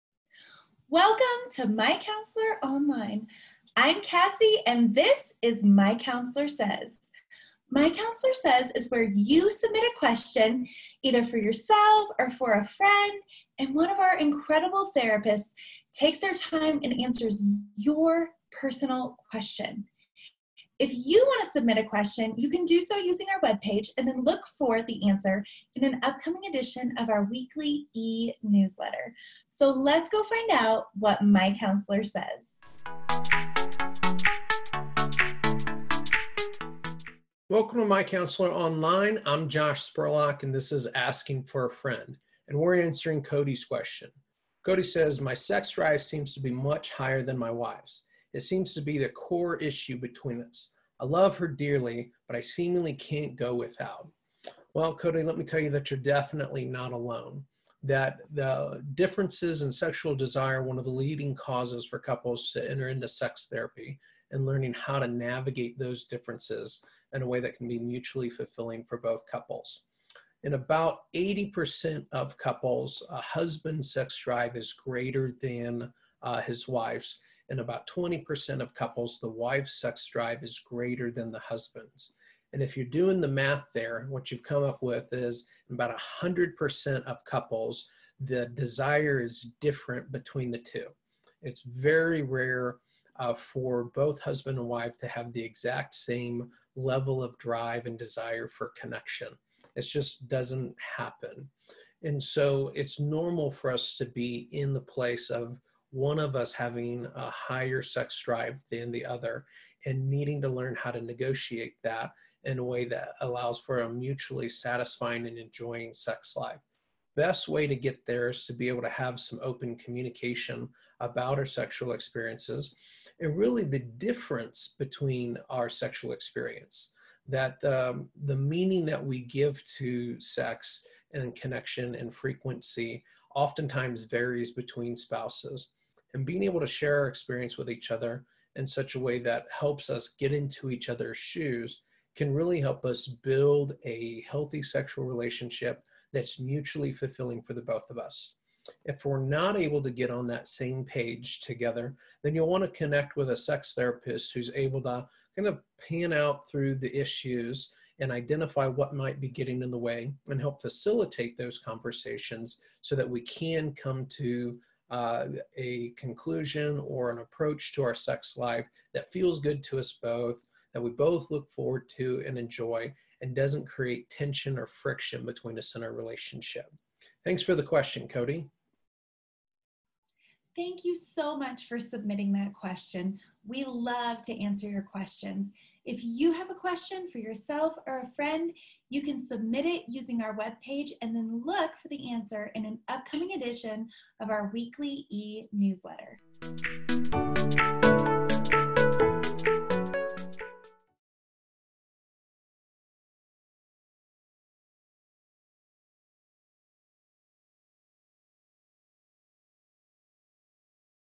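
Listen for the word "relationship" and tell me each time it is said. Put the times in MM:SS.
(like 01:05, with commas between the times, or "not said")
02:25, 02:55.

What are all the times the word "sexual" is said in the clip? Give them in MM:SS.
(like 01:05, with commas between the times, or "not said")
00:59, 02:01, 02:05, 02:24.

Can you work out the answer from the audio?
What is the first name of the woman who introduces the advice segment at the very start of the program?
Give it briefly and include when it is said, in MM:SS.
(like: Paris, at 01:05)
Cassie, at 00:04.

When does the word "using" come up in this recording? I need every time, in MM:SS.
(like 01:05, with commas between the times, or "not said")
00:22, 03:09.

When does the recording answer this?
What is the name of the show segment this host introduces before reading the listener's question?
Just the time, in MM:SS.
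00:40.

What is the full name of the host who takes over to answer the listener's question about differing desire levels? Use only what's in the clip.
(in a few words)
Josh Spurlock.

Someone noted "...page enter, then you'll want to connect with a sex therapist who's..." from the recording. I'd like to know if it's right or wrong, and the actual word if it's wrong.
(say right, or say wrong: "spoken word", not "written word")
wrong: "together", not "enter".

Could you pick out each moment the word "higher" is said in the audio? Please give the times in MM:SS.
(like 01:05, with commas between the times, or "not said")
00:46, 01:47.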